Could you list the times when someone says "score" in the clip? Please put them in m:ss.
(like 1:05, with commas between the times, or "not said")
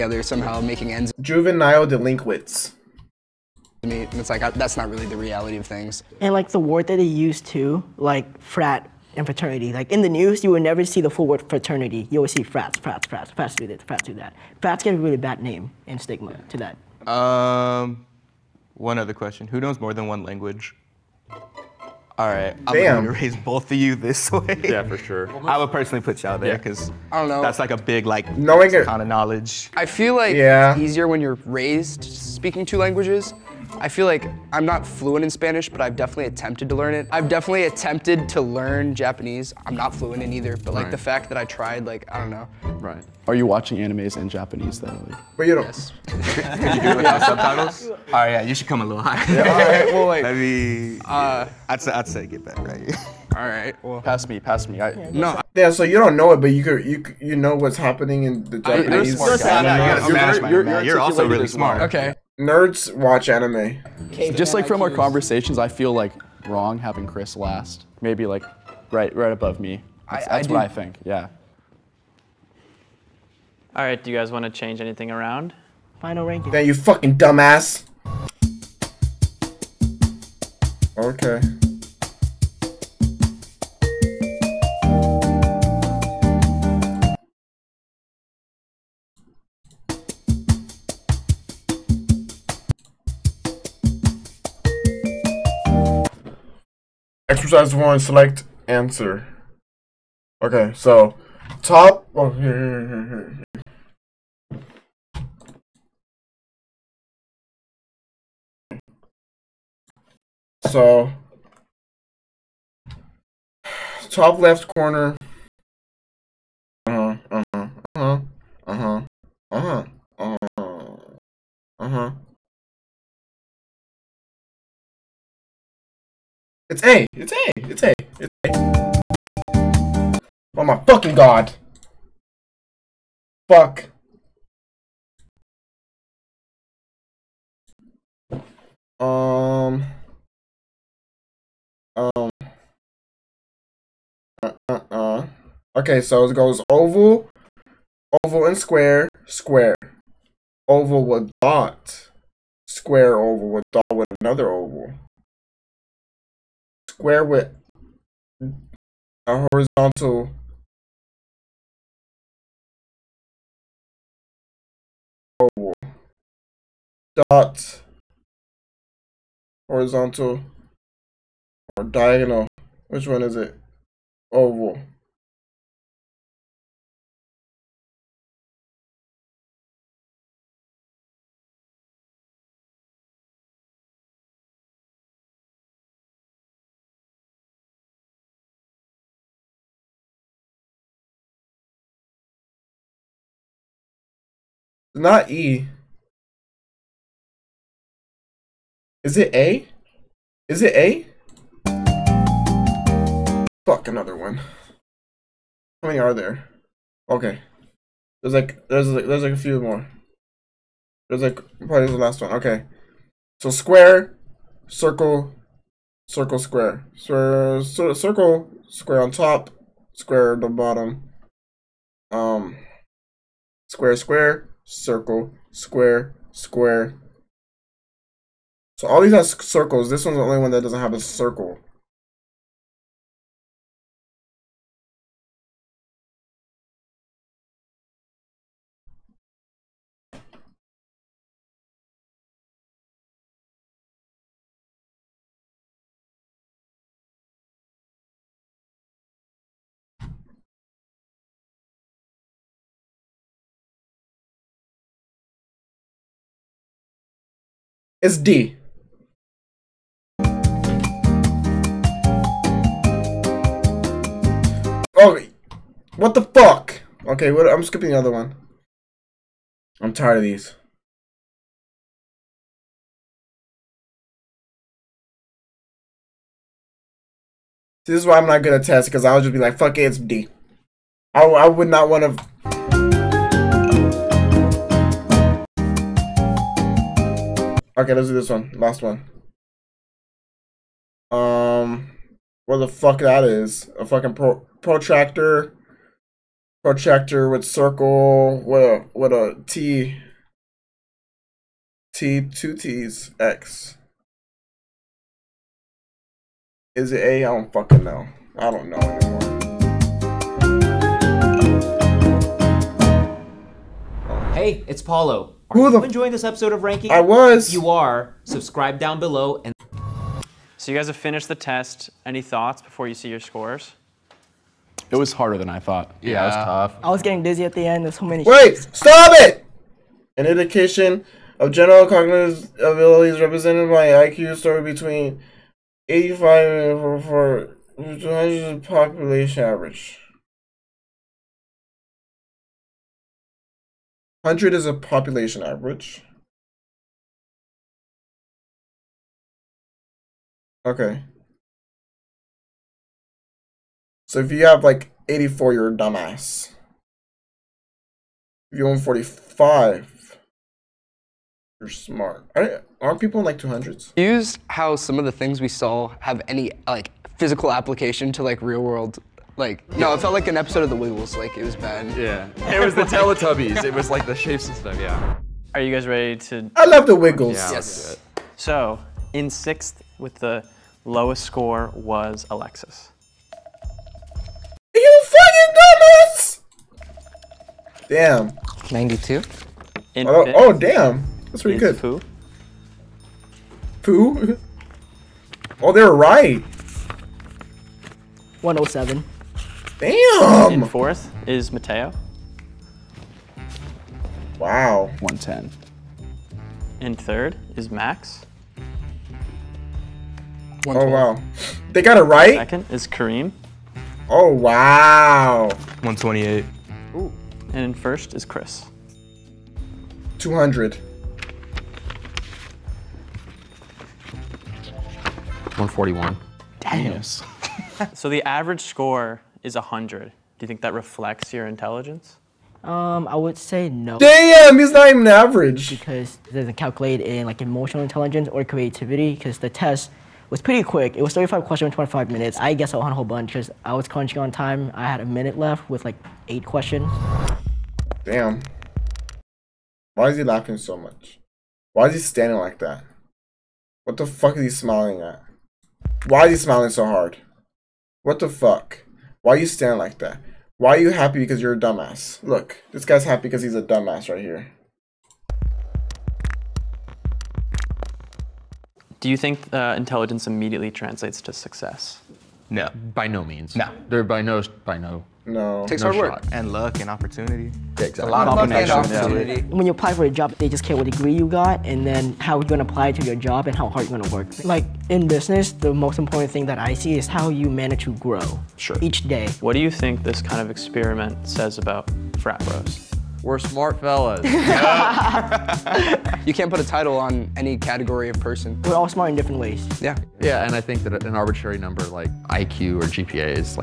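5:23, 5:34, 6:21, 7:08.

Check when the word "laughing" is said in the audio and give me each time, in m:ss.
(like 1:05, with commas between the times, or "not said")
7:30.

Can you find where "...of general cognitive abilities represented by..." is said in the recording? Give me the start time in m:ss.
5:31.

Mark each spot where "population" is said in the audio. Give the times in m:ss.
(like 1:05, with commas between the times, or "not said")
5:38, 5:44.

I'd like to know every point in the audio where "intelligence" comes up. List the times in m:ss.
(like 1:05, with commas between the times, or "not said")
7:11, 7:17, 7:49.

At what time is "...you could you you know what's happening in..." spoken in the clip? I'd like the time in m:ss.
0:56.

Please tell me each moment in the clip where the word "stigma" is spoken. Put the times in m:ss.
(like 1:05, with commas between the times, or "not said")
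0:15.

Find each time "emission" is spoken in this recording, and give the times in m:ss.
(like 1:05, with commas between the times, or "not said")
not said.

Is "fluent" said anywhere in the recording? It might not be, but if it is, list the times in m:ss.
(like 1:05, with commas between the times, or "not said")
0:34, 0:39.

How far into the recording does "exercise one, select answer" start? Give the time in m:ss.
1:37.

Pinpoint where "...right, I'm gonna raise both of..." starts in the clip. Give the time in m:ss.
0:22.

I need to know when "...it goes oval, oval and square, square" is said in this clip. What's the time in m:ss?
2:26.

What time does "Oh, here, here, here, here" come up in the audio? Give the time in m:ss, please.
1:42.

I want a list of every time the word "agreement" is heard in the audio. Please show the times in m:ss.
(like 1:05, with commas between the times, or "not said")
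not said.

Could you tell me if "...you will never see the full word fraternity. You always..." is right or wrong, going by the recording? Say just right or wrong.
right.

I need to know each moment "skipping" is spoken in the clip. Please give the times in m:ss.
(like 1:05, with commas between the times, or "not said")
4:27.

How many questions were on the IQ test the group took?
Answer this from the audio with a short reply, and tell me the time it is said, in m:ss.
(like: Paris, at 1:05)
35, at 7:21.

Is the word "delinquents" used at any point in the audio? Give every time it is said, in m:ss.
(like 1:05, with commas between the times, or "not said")
0:01.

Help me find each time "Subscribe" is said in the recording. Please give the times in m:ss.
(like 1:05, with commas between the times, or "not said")
5:18.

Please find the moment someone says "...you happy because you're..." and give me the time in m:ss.
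7:40.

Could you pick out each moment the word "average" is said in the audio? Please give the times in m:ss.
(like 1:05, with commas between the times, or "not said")
5:39, 5:45, 7:08, 7:15.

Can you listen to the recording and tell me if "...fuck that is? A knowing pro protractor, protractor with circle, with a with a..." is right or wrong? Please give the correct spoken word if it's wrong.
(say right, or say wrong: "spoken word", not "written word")
wrong: "fucking", not "knowing".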